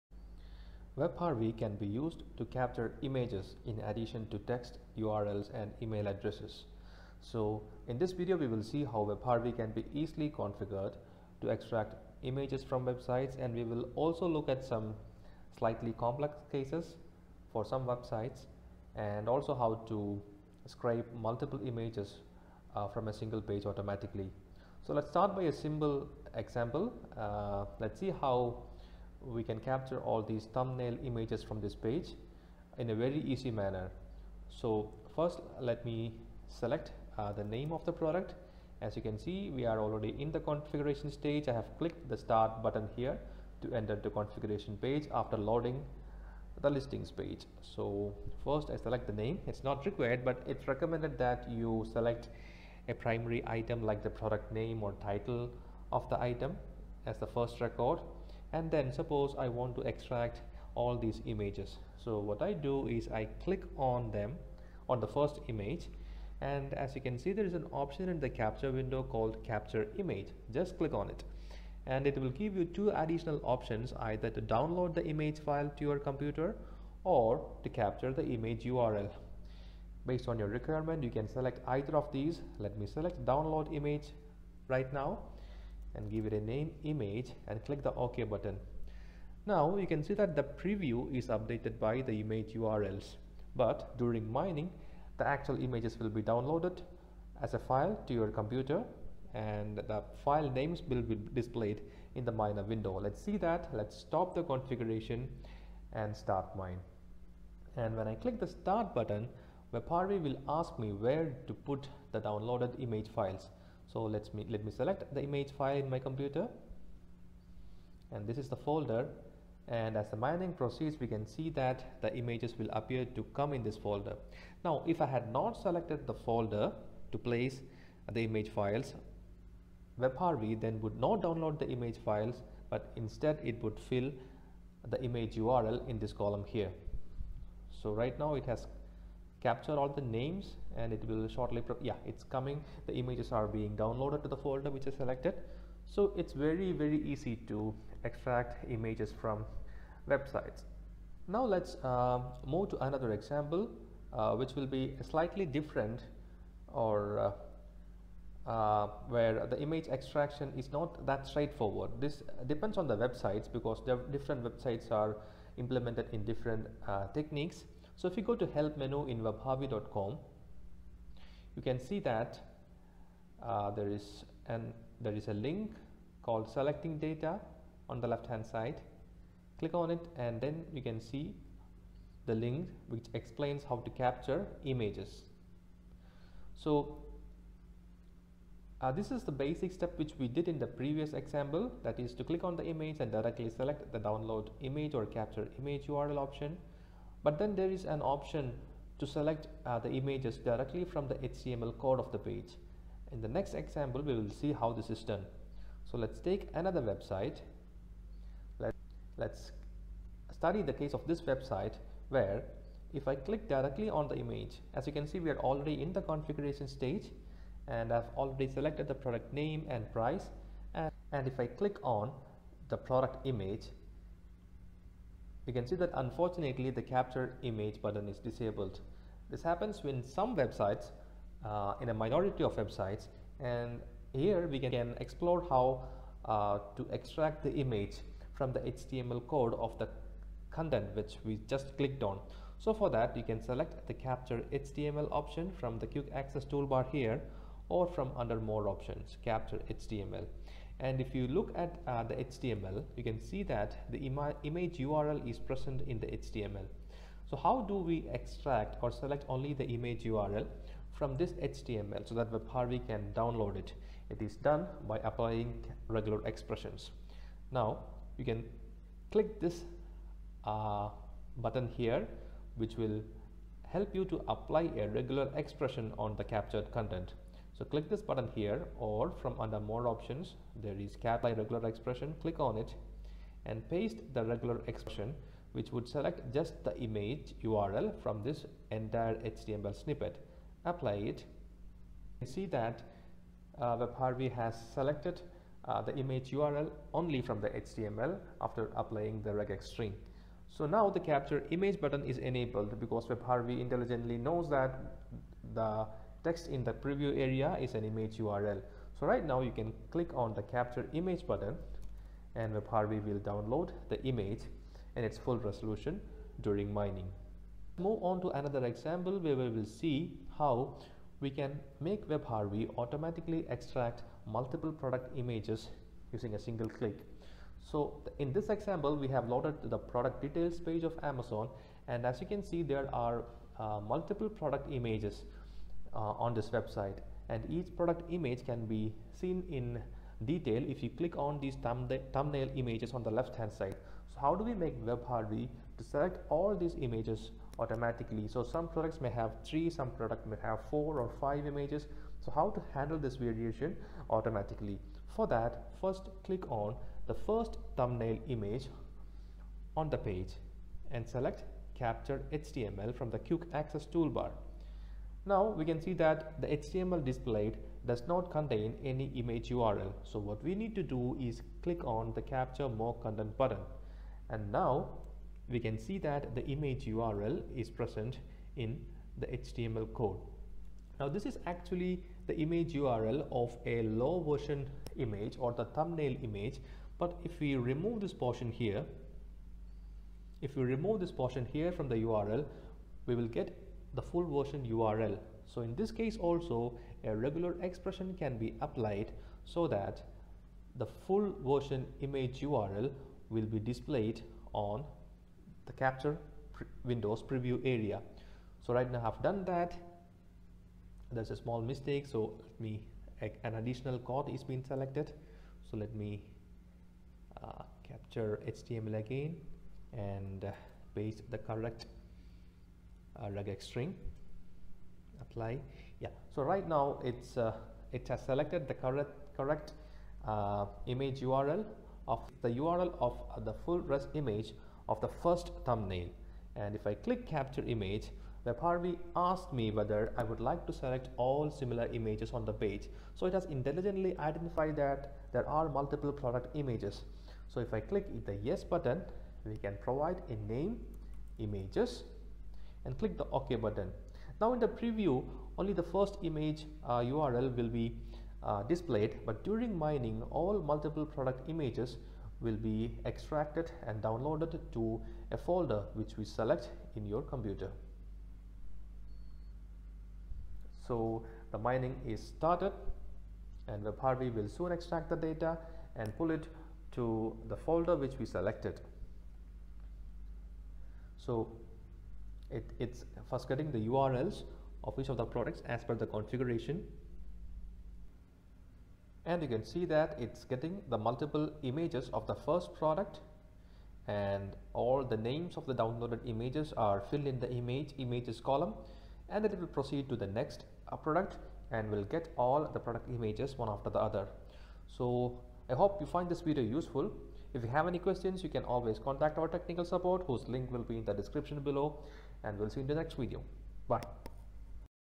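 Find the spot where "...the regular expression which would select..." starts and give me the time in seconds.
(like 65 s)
284 s.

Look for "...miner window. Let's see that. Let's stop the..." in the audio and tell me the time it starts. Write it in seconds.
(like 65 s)
102 s.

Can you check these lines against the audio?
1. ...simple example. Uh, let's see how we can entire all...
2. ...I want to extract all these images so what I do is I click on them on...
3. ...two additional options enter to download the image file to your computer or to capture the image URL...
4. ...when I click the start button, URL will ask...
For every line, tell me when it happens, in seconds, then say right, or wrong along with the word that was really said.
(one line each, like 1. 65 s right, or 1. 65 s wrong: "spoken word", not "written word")
1. 25 s wrong: "capture", not "entire"
2. 59 s right
3. 72 s wrong: "either", not "enter"
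4. 107 s wrong: "WebHarvy", not "URL".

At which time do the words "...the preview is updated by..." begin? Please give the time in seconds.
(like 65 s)
90 s.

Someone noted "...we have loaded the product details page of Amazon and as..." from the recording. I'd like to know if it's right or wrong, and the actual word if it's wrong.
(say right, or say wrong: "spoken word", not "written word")
right.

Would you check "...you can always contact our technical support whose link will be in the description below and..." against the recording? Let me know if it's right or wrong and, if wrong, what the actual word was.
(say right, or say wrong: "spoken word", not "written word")
right.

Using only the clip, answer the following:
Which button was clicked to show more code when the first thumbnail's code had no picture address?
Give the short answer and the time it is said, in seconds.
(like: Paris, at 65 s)
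capture more content, at 372 s.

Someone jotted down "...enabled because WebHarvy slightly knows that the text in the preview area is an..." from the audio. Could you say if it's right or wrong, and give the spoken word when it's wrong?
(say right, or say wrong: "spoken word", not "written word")
wrong: "intelligently", not "slightly".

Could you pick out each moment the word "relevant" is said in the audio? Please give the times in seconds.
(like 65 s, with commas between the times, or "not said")
not said.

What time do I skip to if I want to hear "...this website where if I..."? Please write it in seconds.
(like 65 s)
211 s.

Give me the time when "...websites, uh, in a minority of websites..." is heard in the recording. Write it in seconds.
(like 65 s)
230 s.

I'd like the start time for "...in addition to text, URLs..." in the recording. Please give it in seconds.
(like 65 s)
3 s.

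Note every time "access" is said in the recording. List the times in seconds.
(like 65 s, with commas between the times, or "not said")
246 s, 363 s.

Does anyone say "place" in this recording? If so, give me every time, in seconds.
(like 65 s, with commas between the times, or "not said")
127 s.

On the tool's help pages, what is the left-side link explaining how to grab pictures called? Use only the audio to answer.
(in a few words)
selecting data.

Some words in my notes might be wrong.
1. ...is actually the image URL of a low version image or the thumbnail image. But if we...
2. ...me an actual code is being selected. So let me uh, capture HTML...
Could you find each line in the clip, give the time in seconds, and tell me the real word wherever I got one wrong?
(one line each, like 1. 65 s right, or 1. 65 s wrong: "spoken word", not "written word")
1. 381 s right
2. 412 s wrong: "additional", not "actual".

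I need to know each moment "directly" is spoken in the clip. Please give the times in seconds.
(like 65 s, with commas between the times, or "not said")
193 s, 200 s, 213 s.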